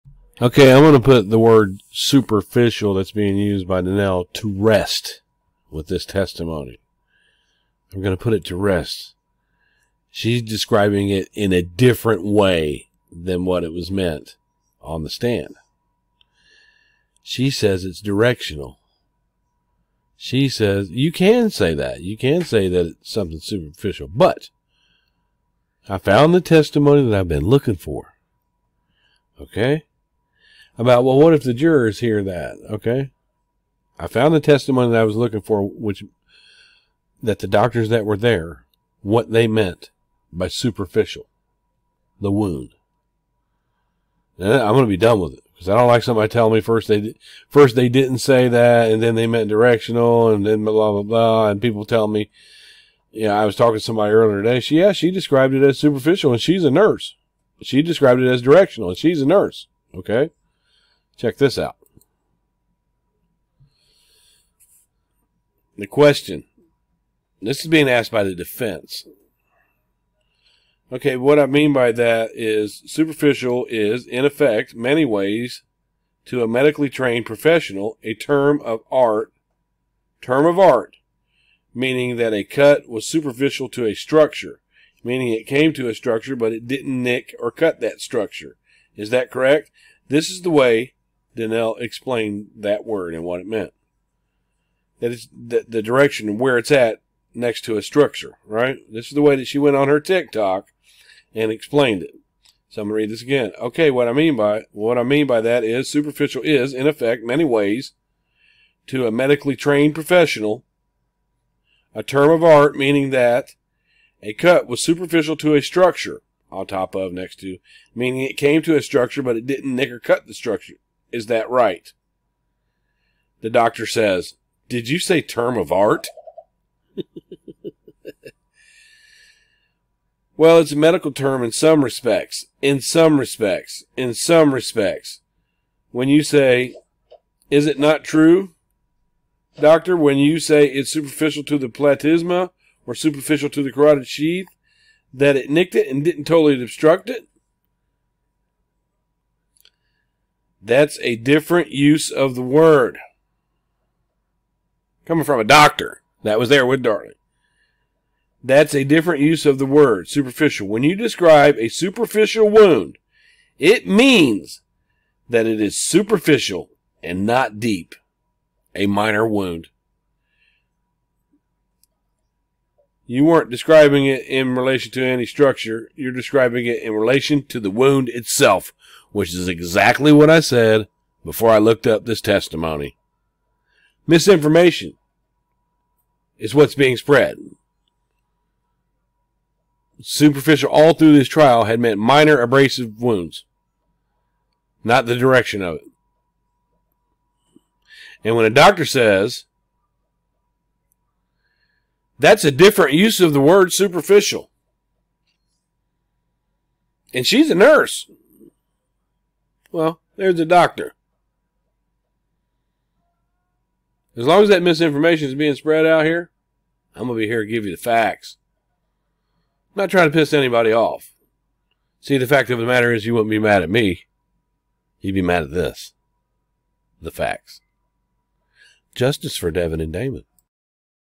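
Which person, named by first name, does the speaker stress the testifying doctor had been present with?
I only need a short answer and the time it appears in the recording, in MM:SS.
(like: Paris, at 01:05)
Darlie, at 02:36.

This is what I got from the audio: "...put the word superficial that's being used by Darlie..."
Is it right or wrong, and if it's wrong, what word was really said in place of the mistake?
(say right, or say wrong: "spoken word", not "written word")
wrong: "Danell", not "Darlie".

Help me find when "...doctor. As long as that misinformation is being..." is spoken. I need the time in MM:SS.
03:30.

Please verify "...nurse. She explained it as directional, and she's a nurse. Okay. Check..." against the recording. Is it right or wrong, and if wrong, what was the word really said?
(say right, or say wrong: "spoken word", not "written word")
wrong: "described", not "explained".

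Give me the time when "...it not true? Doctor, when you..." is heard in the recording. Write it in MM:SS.
02:17.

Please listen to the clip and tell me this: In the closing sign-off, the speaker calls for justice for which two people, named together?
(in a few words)
Devon and Damon.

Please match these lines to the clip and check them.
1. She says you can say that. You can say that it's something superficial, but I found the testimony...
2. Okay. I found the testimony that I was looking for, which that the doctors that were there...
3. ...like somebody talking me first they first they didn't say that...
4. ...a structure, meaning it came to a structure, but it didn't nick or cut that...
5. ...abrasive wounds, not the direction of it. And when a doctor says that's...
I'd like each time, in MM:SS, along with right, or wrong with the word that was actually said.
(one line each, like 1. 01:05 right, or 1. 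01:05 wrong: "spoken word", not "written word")
1. 00:20 right
2. 00:32 right
3. 00:45 wrong: "telling", not "talking"
4. 01:23 right
5. 03:12 right.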